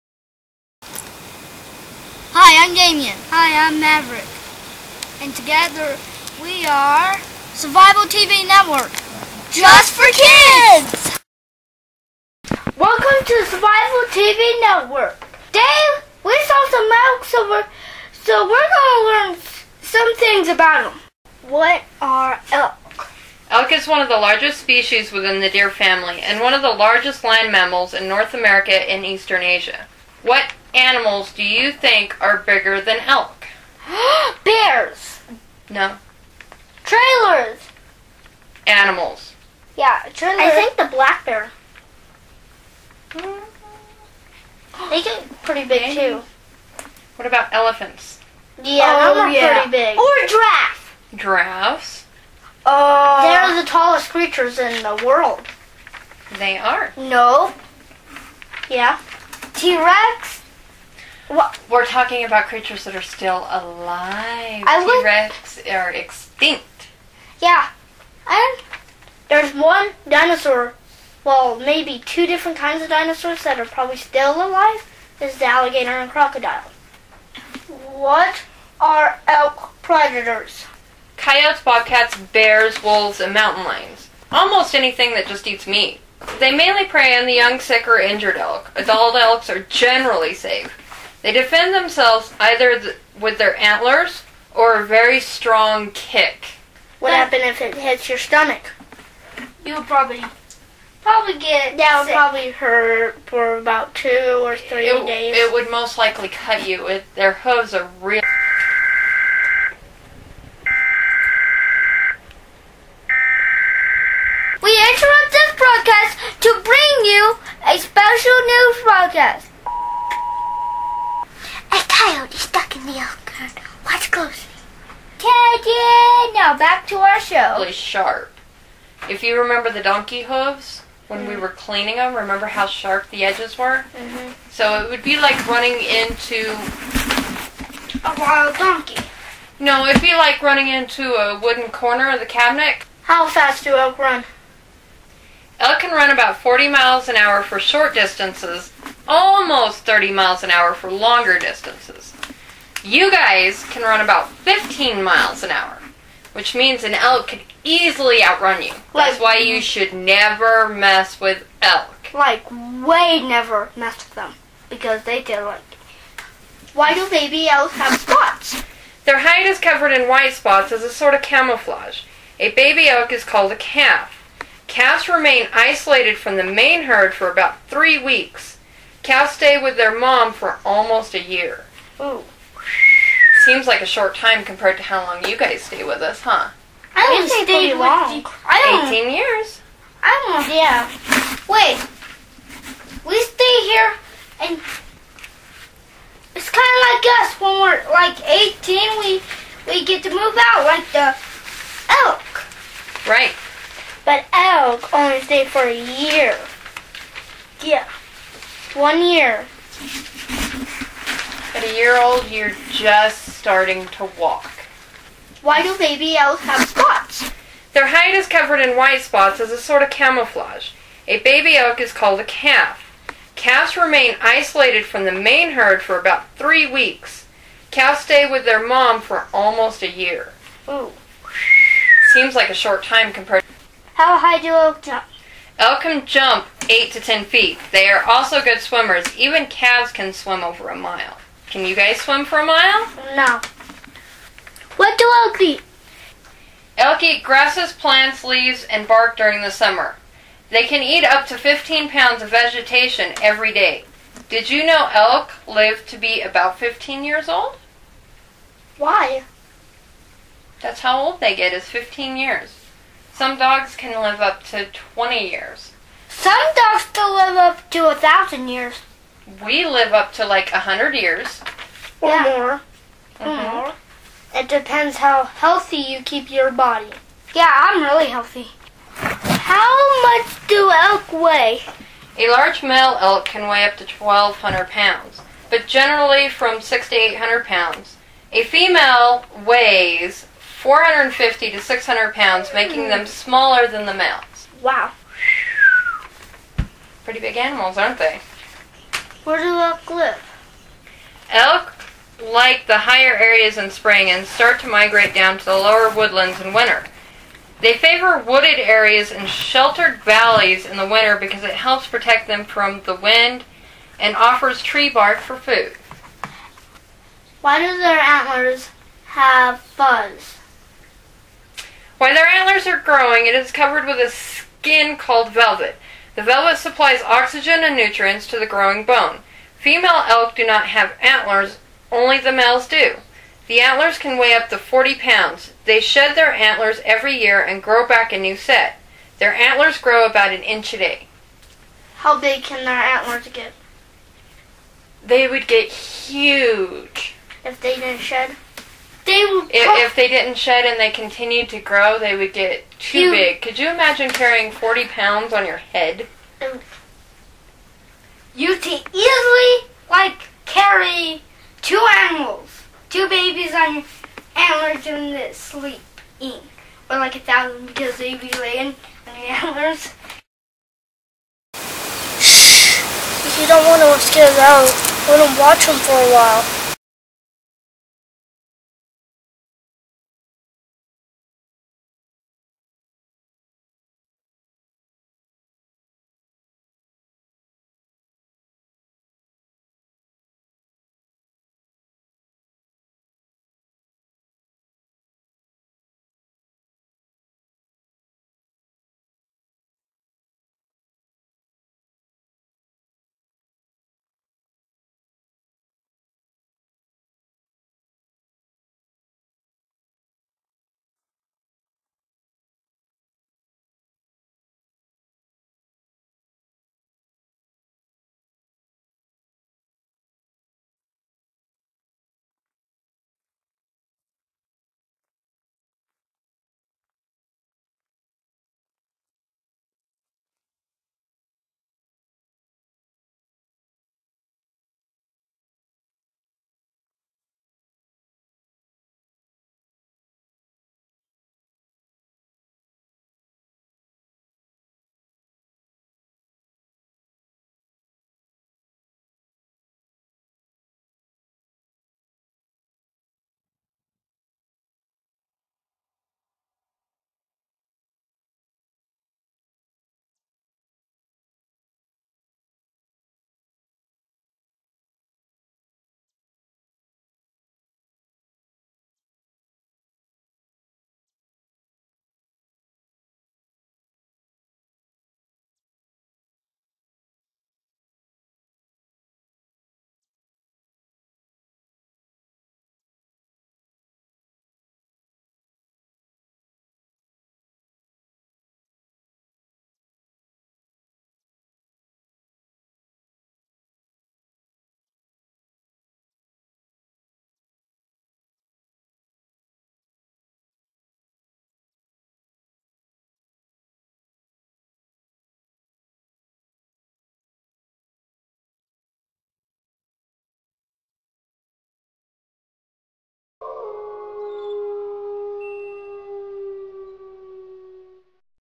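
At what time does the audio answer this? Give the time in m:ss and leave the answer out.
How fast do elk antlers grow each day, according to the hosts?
5:40.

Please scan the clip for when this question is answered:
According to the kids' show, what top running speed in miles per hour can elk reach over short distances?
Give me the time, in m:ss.
2:26.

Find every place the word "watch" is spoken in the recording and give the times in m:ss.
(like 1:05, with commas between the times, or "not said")
2:02, 6:15.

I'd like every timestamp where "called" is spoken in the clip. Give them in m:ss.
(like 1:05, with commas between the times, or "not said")
2:53, 3:41, 5:24.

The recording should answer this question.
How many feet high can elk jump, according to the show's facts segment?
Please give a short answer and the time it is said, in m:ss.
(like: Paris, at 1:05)
8 to 10 feet, at 3:56.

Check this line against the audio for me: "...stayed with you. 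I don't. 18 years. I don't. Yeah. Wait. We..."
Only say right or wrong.
right.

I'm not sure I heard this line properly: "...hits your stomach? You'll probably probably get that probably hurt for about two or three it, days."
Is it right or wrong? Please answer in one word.
right.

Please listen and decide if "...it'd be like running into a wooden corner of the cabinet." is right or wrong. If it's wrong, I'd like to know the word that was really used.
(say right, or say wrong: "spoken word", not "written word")
right.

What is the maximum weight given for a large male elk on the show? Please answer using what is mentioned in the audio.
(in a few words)
1,200 pounds.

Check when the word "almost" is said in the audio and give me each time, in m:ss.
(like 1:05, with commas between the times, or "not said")
1:24, 2:29, 3:00, 3:49.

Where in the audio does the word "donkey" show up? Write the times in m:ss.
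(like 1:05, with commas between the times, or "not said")
2:09, 2:18.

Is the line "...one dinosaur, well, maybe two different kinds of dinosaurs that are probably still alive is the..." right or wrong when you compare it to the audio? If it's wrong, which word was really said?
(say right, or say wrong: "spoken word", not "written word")
right.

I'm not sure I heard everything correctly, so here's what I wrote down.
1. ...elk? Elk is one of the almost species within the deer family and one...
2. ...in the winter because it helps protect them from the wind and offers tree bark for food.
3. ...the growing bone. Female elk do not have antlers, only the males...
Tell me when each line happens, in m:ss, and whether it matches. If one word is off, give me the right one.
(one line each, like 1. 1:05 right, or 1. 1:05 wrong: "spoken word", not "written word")
1. 0:22 wrong: "largest", not "almost"
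2. 5:10 right
3. 5:28 right.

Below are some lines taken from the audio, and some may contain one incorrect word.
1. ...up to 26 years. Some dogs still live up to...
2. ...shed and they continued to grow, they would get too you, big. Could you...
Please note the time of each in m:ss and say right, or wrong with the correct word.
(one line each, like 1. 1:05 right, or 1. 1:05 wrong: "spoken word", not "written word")
1. 4:24 wrong: "20", not "26"
2. 5:50 right.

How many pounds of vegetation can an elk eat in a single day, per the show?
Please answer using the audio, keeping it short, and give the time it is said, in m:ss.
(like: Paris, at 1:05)
15 pounds, at 4:11.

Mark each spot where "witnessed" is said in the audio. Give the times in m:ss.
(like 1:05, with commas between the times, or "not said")
not said.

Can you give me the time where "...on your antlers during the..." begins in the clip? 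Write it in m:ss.
6:03.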